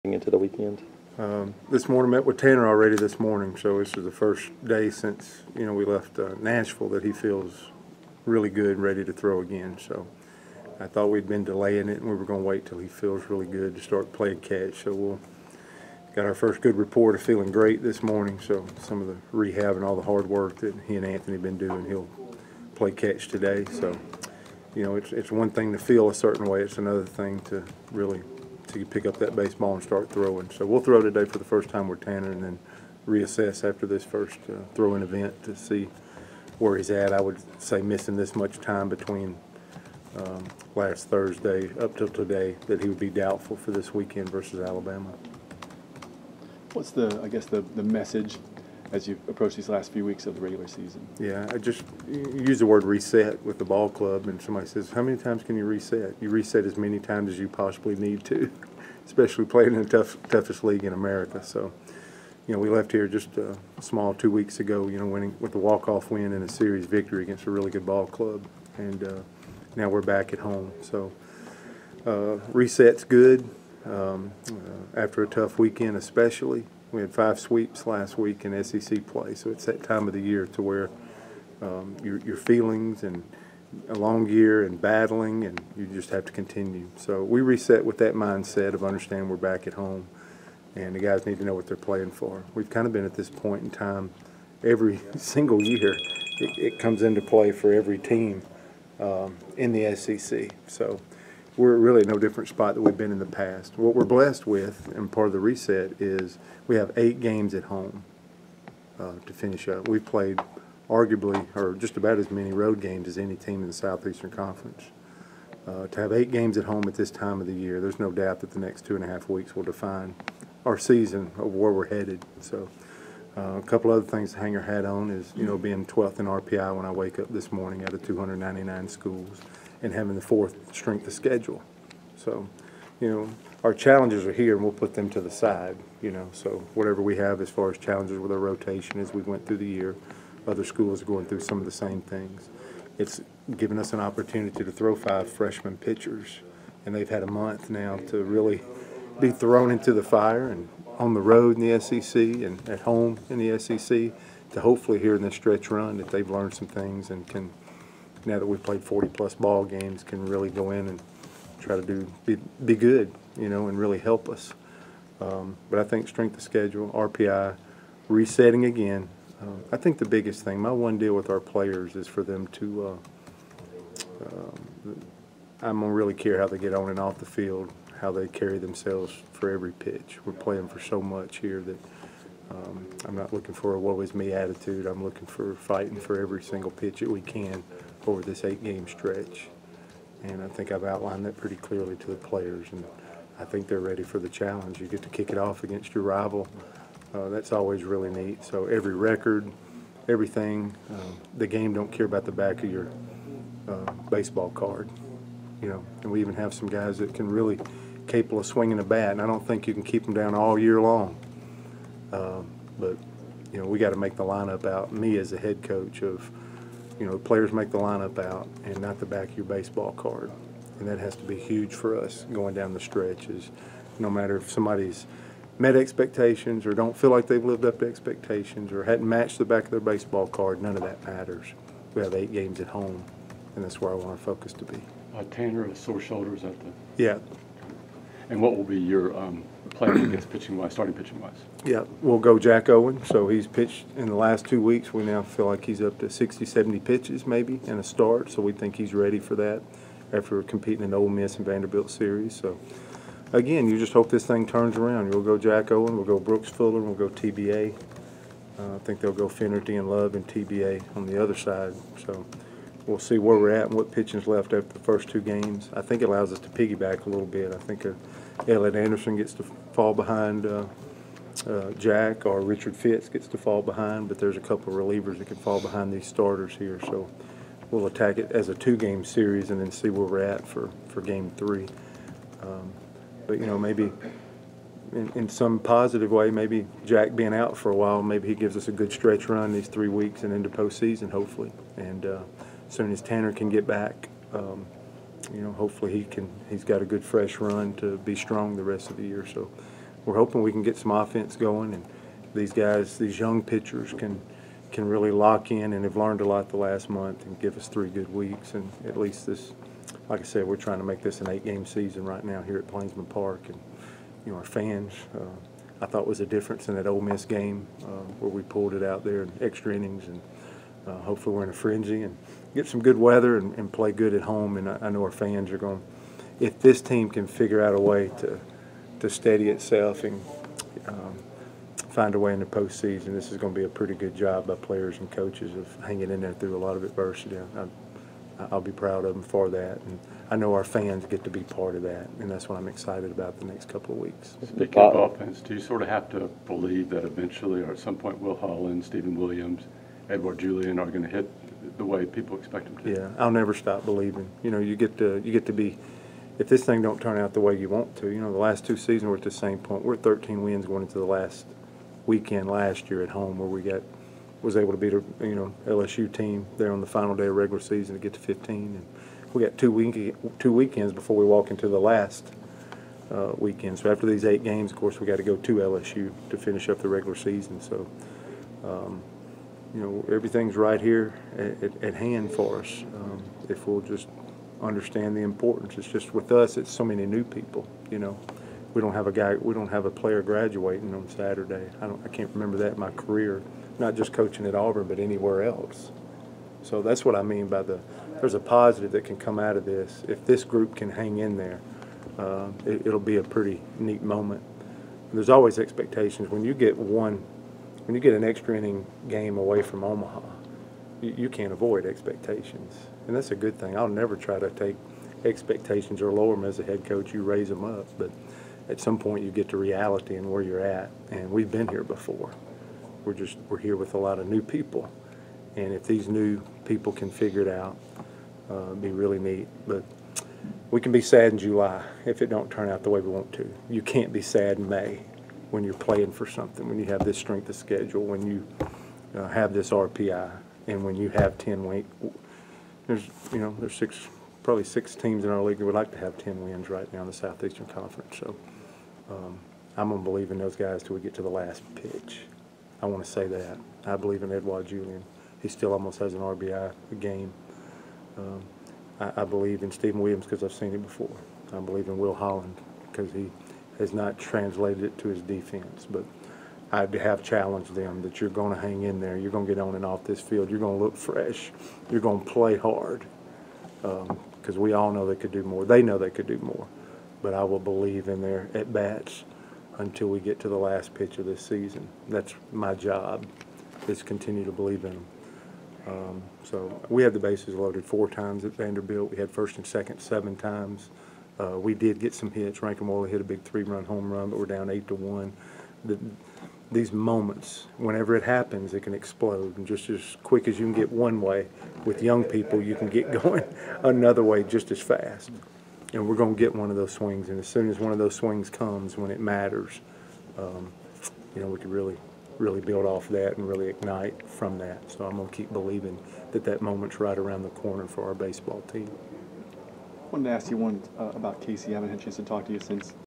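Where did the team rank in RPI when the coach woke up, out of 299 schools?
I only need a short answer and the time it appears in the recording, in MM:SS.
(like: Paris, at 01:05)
12th, at 02:05.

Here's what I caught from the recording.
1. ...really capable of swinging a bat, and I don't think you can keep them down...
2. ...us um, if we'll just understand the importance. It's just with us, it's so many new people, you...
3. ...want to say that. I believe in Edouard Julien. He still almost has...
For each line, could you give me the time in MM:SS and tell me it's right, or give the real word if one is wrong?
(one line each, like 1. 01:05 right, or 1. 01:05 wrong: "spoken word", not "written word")
1. 03:27 right
2. 06:22 right
3. 07:32 right.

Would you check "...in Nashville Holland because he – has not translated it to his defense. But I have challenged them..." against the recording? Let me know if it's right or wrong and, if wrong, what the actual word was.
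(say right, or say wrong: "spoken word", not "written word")
wrong: "Will", not "Nashville".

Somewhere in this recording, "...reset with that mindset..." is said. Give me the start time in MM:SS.
01:27.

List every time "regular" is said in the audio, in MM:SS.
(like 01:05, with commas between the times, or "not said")
00:50, 06:07, 06:16.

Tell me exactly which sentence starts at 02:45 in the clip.
Um, but I think strength of schedule, RPI, resetting again.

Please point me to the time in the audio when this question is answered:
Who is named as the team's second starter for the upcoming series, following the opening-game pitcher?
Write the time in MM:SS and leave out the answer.
04:16.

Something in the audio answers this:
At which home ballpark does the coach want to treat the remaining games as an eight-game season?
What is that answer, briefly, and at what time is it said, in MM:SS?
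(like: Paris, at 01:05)
Plainsman Park, at 05:12.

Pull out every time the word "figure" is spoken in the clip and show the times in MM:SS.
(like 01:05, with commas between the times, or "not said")
05:27, 07:07.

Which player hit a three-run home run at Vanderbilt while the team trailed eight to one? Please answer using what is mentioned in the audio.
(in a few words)
Rankin Woley.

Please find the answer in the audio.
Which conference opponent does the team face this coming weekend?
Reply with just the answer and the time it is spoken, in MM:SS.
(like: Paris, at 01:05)
Alabama, at 00:44.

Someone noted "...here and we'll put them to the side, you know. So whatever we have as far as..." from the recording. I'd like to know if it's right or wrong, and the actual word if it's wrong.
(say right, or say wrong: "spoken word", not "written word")
right.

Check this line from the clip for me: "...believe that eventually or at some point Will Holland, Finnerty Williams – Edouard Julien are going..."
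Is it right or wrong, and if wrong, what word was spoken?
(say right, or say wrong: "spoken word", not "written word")
wrong: "Steven", not "Finnerty".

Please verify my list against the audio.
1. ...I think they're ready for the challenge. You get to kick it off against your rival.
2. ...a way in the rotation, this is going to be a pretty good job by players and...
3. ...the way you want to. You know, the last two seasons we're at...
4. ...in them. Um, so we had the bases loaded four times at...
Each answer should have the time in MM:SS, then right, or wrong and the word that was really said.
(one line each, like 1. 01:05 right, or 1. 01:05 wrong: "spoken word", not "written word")
1. 03:13 right
2. 05:32 wrong: "postseason", not "rotation"
3. 05:57 right
4. 08:04 right.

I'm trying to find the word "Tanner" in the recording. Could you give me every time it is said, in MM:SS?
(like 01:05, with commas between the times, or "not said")
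00:02, 00:32, 03:55, 04:53.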